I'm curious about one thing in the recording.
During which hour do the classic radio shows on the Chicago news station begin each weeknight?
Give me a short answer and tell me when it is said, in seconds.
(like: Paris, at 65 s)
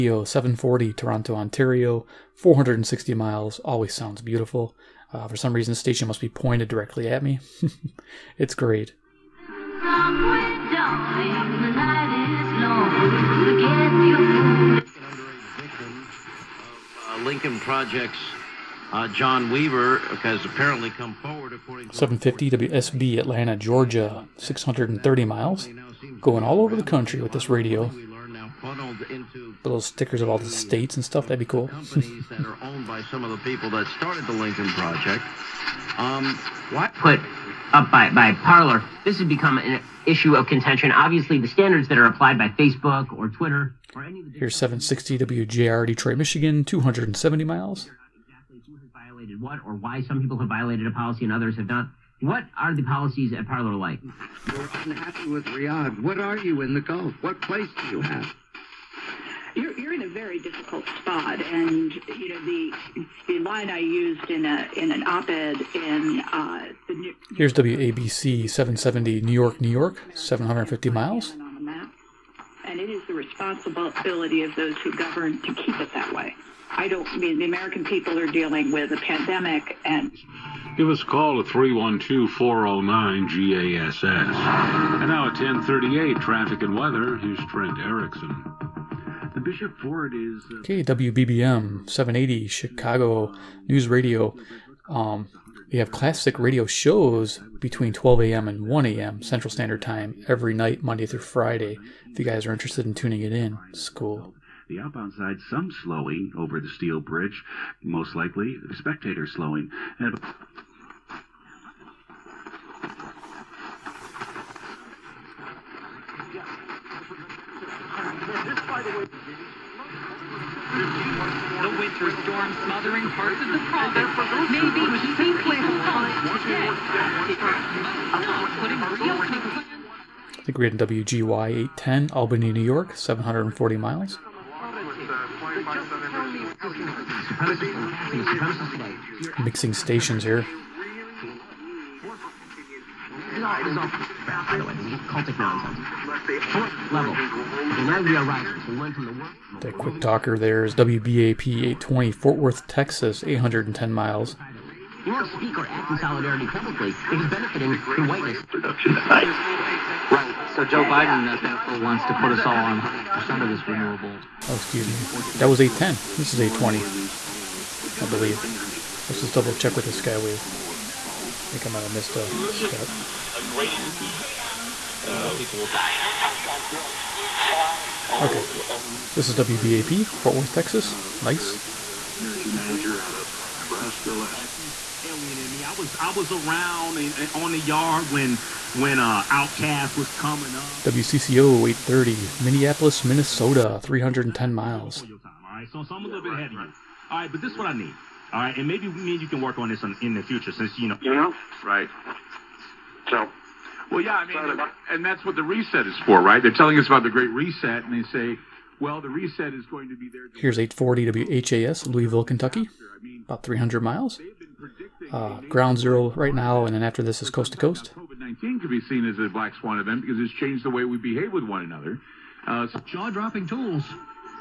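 12 a.m., at 97 s.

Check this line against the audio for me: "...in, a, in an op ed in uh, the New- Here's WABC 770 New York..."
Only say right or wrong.
right.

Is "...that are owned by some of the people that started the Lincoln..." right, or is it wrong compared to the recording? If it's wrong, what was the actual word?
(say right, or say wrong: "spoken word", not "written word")
right.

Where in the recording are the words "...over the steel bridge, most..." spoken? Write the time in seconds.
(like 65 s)
106 s.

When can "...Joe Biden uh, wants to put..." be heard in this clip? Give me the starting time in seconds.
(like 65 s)
160 s.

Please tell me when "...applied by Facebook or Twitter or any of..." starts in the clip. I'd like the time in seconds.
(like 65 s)
42 s.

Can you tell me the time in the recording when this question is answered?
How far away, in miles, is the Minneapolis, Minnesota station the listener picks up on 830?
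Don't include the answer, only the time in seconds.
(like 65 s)
193 s.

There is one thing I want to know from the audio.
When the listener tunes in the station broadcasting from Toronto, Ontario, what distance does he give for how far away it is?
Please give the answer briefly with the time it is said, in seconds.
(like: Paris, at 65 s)
460 miles, at 2 s.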